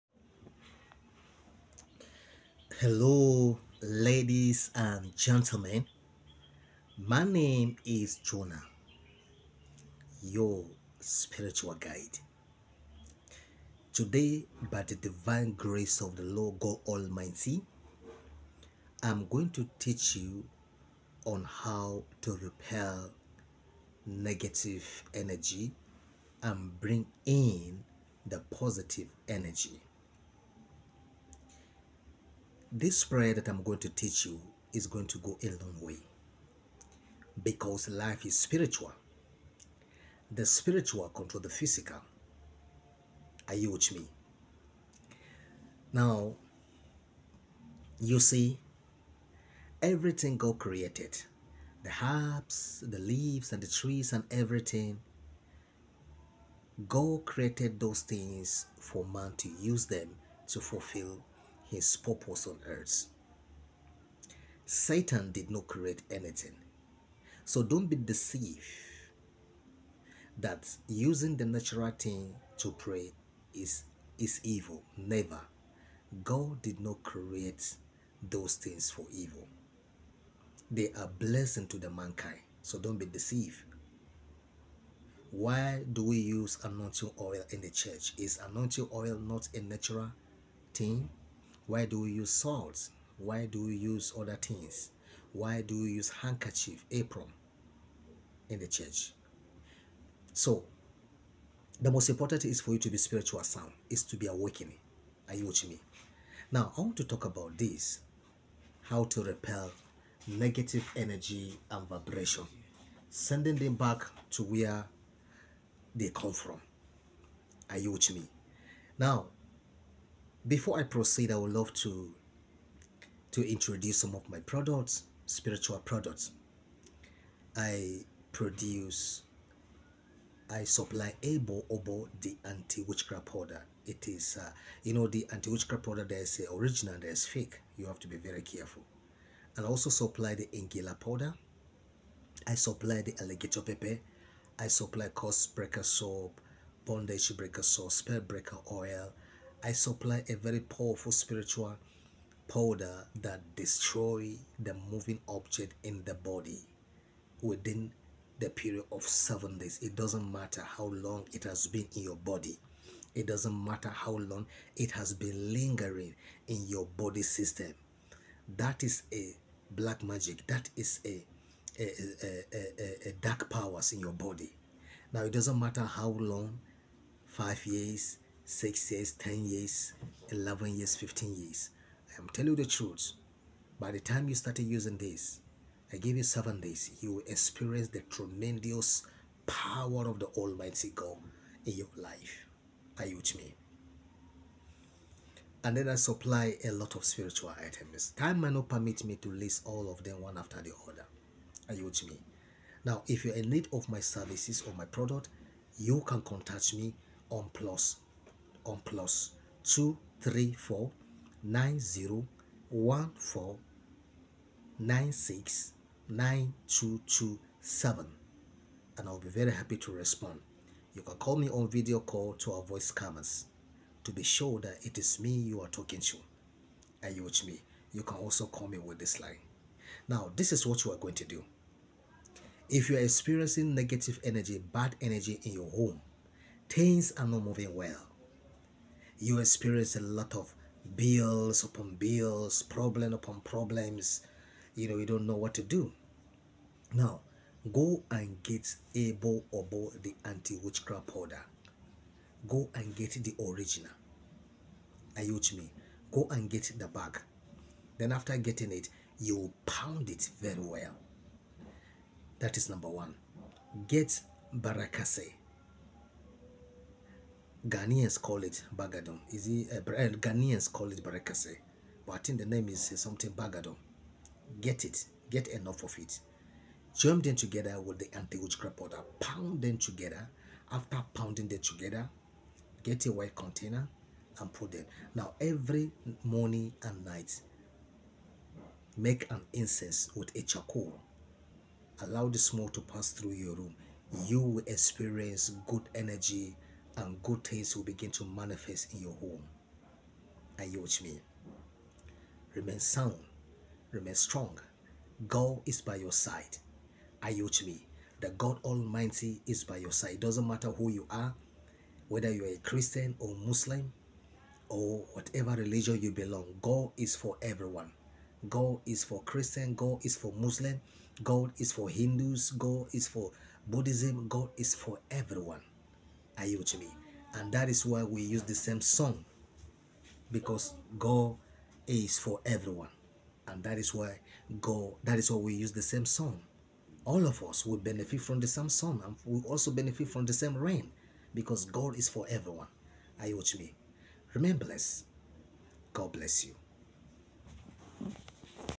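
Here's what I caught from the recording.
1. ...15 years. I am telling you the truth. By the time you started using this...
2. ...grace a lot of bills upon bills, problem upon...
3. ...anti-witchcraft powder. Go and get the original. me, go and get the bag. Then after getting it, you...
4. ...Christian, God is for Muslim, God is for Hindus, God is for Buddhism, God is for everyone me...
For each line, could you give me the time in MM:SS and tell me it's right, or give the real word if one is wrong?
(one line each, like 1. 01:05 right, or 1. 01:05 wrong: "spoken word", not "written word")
1. 03:00 right
2. 03:59 wrong: "experience", not "grace"
3. 04:10 right
4. 05:19 right.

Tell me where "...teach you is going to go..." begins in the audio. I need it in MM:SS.
00:33.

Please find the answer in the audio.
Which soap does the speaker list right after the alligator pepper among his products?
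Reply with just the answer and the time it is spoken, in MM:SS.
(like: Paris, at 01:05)
curse breaker soap, at 02:25.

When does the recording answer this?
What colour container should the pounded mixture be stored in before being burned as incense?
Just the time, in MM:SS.
04:43.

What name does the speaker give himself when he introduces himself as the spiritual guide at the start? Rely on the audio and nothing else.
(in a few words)
Jonah.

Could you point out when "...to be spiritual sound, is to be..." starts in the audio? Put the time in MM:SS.
01:42.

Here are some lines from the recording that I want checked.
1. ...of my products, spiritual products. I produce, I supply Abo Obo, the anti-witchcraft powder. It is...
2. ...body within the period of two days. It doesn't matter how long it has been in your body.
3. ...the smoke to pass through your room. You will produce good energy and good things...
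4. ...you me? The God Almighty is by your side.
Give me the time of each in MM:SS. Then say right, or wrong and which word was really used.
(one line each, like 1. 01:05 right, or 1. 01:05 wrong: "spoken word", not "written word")
1. 02:04 right
2. 02:36 wrong: "seven", not "two"
3. 04:52 wrong: "experience", not "produce"
4. 05:07 right.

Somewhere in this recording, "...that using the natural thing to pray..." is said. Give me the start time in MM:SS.
01:10.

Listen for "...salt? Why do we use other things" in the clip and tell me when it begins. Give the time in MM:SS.
01:32.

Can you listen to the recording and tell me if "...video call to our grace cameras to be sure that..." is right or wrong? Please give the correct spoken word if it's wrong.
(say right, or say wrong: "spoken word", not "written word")
wrong: "voice", not "grace".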